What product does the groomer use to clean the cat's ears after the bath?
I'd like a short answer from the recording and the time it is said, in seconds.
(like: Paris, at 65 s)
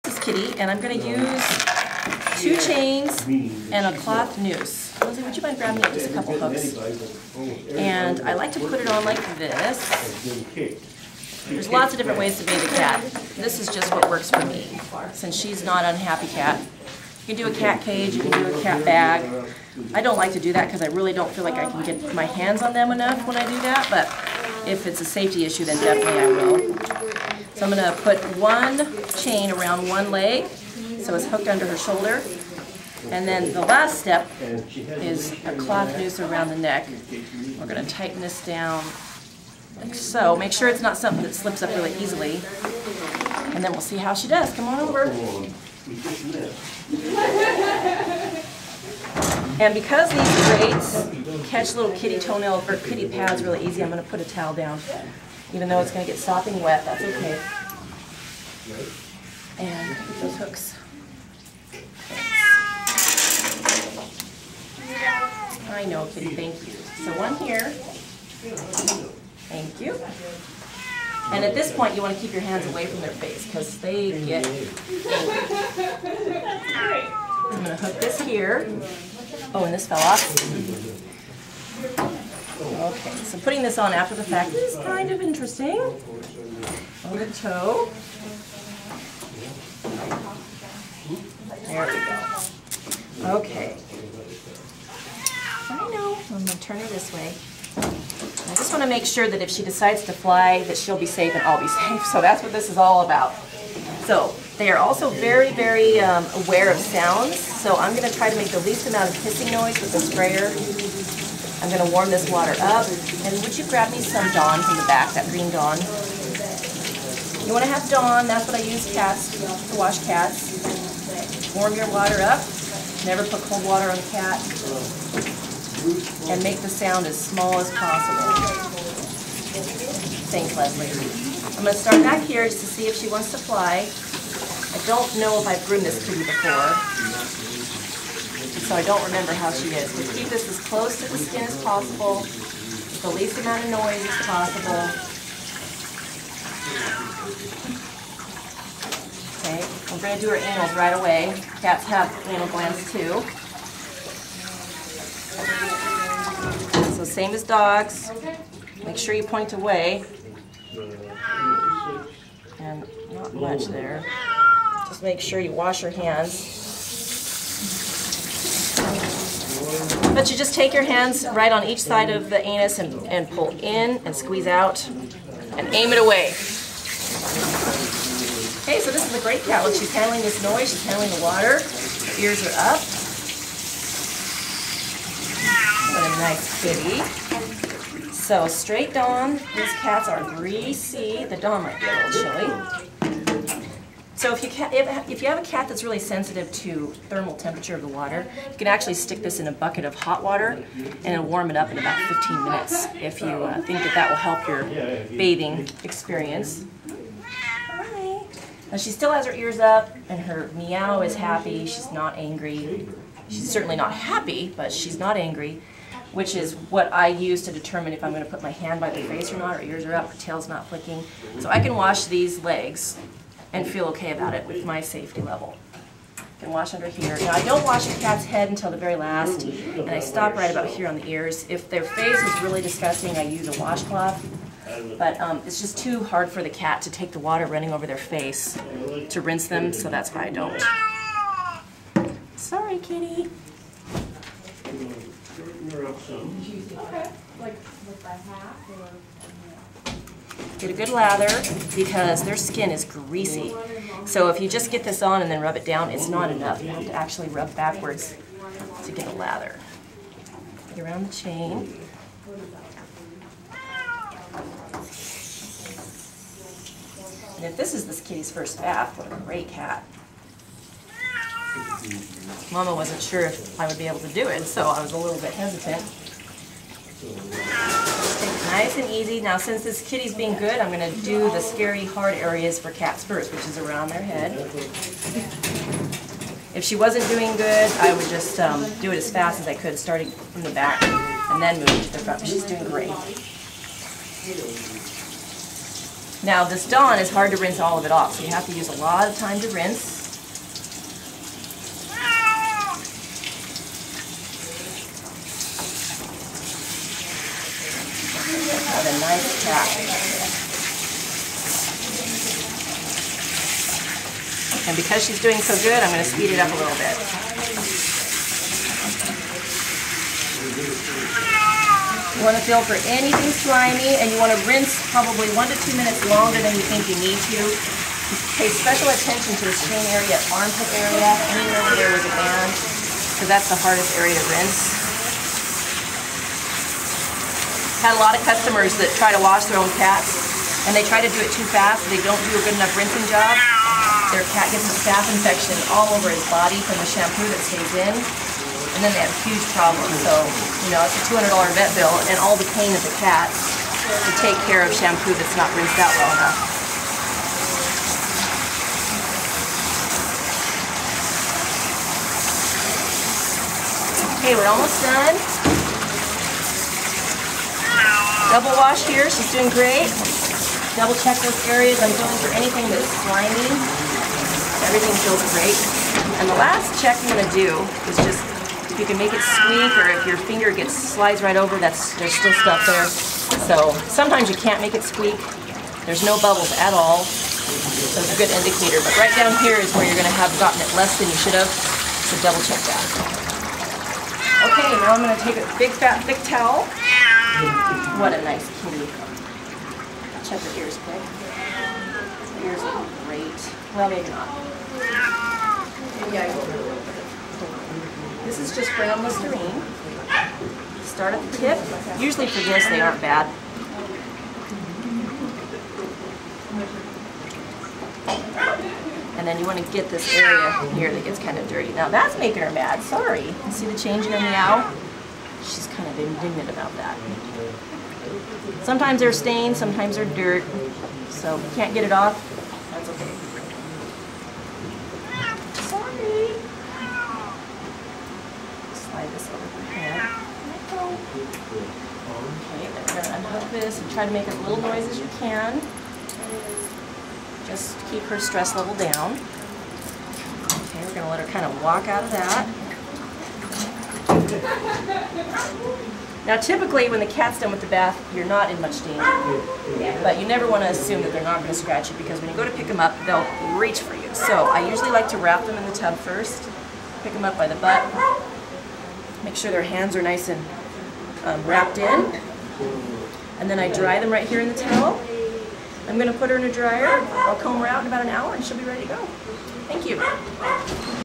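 brown Listerine, at 408 s.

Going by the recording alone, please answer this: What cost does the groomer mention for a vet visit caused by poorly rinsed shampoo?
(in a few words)
$200.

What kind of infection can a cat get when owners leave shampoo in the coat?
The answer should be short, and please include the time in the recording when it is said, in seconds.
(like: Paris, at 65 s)
staph infection, at 344 s.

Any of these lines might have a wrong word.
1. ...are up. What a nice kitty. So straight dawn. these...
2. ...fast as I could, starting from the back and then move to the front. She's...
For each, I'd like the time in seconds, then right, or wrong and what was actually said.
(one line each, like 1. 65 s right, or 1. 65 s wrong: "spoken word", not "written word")
1. 182 s right
2. 289 s right.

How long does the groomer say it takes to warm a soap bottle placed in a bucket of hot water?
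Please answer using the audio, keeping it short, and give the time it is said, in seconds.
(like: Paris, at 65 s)
15 minutes, at 202 s.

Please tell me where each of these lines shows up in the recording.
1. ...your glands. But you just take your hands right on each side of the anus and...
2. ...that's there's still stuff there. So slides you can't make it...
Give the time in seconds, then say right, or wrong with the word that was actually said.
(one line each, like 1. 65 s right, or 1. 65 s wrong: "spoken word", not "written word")
1. 165 s wrong: "hands", not "glands"
2. 381 s wrong: "sometimes", not "slides".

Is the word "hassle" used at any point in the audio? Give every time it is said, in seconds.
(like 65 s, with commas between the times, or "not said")
not said.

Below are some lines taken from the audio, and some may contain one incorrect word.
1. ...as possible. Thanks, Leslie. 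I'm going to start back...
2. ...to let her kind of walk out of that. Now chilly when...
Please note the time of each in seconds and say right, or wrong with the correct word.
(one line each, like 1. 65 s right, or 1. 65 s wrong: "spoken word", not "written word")
1. 127 s right
2. 451 s wrong: "typically", not "chilly".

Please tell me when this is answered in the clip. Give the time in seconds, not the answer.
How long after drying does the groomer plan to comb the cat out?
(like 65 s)
477 s.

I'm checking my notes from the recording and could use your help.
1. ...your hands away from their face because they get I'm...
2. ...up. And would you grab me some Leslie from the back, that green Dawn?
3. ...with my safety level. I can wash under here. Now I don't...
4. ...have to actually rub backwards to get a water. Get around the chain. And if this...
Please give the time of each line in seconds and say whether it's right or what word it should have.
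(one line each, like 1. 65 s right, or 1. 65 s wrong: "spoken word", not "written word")
1. 72 s right
2. 112 s wrong: "Dawn", not "Leslie"
3. 224 s right
4. 256 s wrong: "lather", not "water".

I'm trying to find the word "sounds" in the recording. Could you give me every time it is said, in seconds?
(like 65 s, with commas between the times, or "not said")
106 s, 126 s.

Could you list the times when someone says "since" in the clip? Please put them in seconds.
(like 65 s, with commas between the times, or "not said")
15 s, 279 s.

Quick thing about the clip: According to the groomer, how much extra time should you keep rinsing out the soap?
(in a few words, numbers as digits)
1 to 2 minutes.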